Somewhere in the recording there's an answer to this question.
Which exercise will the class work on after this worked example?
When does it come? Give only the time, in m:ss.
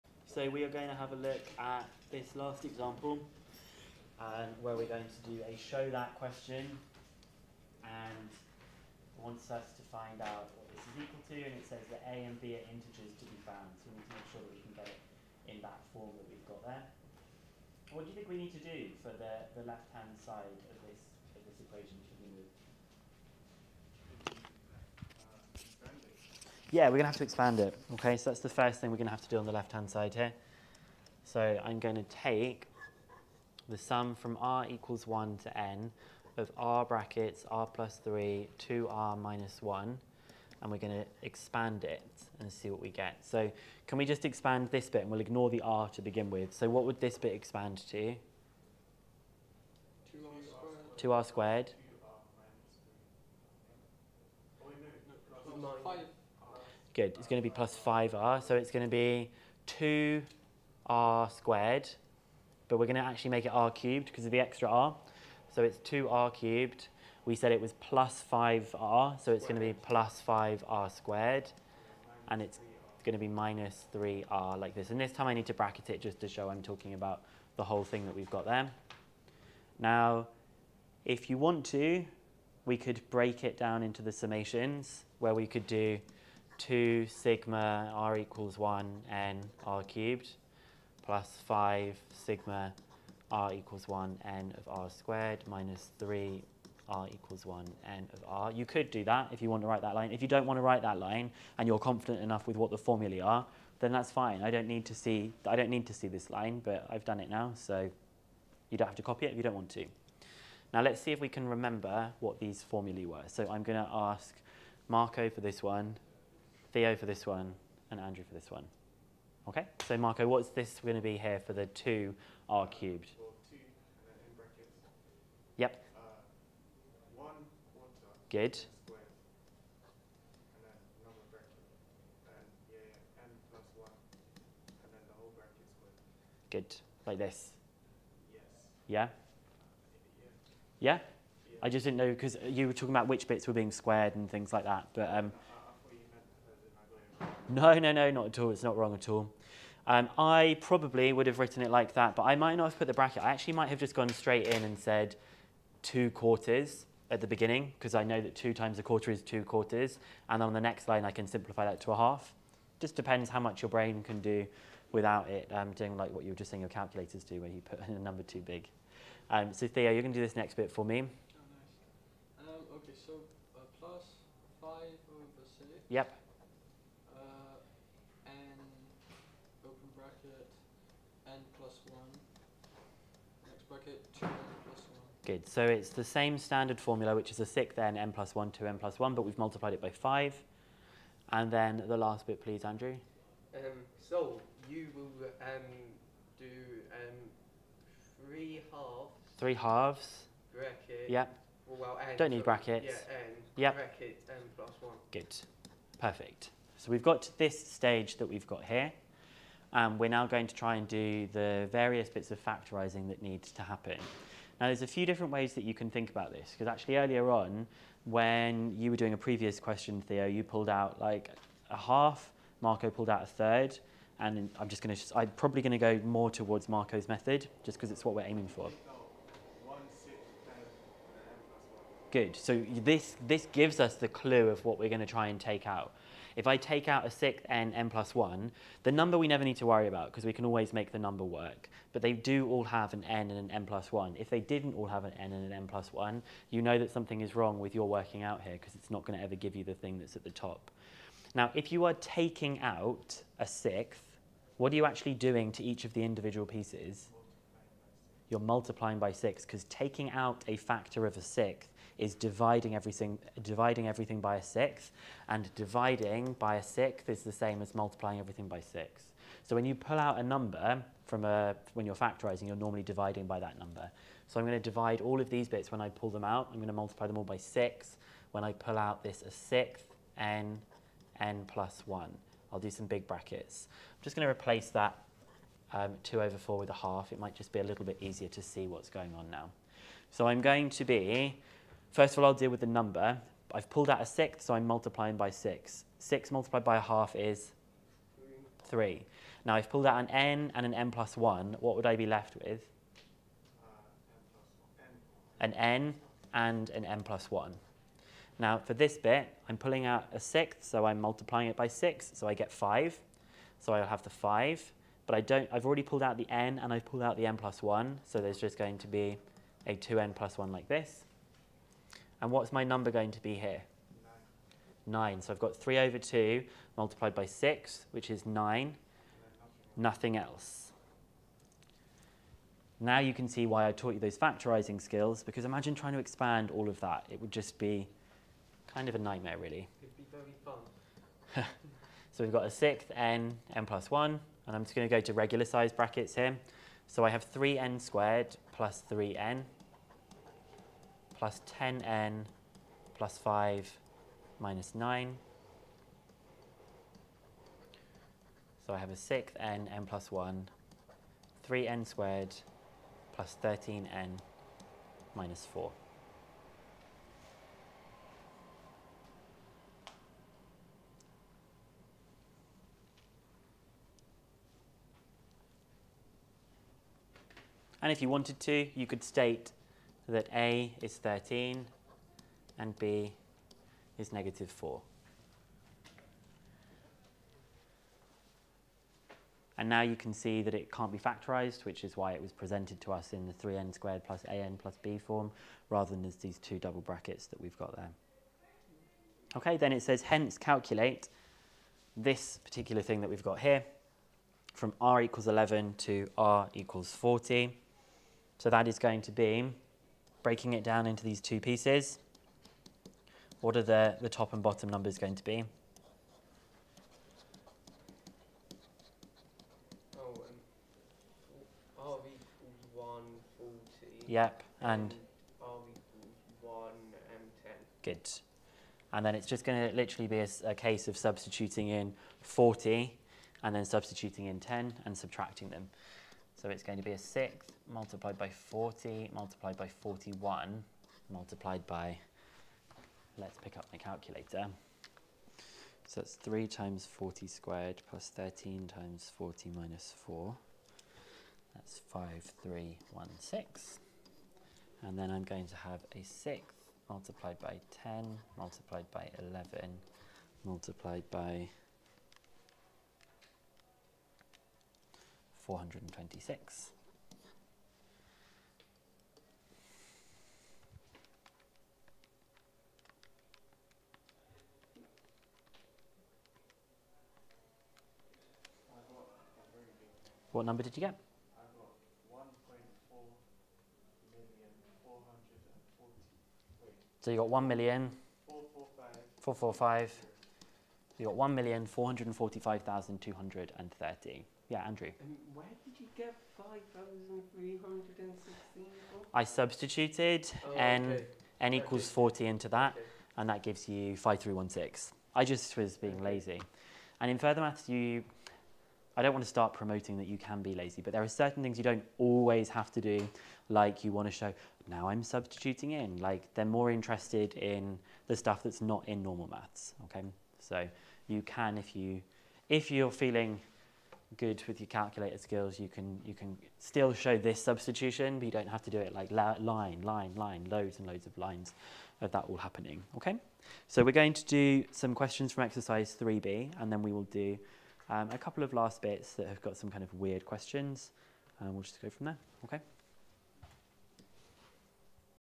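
8:55.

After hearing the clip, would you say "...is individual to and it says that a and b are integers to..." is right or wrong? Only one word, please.
wrong.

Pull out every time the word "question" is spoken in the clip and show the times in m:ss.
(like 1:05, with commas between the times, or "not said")
0:06, 3:39, 8:54, 9:00.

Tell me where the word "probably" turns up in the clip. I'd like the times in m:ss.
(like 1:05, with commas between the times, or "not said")
2:30, 3:45.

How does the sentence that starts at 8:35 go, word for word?
Like they're more interested in the stuff that's not in normal maths, okay?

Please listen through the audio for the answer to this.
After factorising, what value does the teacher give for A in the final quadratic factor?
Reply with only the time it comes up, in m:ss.
6:20.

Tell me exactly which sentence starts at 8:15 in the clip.
where did you get 5,316 I substituted oh, n, okay.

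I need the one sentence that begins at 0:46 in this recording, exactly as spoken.
So what would this bit expand to?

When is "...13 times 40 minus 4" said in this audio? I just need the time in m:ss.
7:28.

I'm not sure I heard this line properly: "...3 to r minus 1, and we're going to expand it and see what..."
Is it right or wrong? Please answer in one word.
right.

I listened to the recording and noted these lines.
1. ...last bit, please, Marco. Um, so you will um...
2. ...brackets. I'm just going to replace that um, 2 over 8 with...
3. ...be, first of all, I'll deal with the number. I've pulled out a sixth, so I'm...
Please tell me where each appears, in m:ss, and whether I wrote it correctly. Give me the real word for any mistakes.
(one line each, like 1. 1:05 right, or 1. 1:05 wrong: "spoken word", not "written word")
1. 3:11 wrong: "Andrew", not "Marco"
2. 4:43 wrong: "4", not "8"
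3. 4:50 right.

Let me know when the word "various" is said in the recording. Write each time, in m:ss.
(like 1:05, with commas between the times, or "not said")
3:31.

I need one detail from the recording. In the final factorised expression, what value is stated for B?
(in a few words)
-4.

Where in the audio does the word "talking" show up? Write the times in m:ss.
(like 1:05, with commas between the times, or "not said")
1:16, 2:22.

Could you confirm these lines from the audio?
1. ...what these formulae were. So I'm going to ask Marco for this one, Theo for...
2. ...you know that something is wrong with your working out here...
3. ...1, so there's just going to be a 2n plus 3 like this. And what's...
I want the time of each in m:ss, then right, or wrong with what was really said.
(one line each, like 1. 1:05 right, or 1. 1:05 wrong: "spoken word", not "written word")
1. 1:52 right
2. 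4:06 right
3. 5:17 wrong: "1", not "3".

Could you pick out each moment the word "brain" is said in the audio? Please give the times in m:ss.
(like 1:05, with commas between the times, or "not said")
2:43.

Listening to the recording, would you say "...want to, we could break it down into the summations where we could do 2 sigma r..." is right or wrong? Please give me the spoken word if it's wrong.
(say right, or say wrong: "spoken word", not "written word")
right.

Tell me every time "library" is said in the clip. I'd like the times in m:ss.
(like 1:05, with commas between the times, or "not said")
not said.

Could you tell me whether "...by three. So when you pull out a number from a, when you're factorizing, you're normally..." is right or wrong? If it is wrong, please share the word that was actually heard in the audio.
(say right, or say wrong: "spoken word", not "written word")
wrong: "six", not "three".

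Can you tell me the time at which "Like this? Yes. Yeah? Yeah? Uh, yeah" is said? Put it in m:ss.
2:17.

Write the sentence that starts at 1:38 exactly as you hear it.
You could do that if you want to write that line.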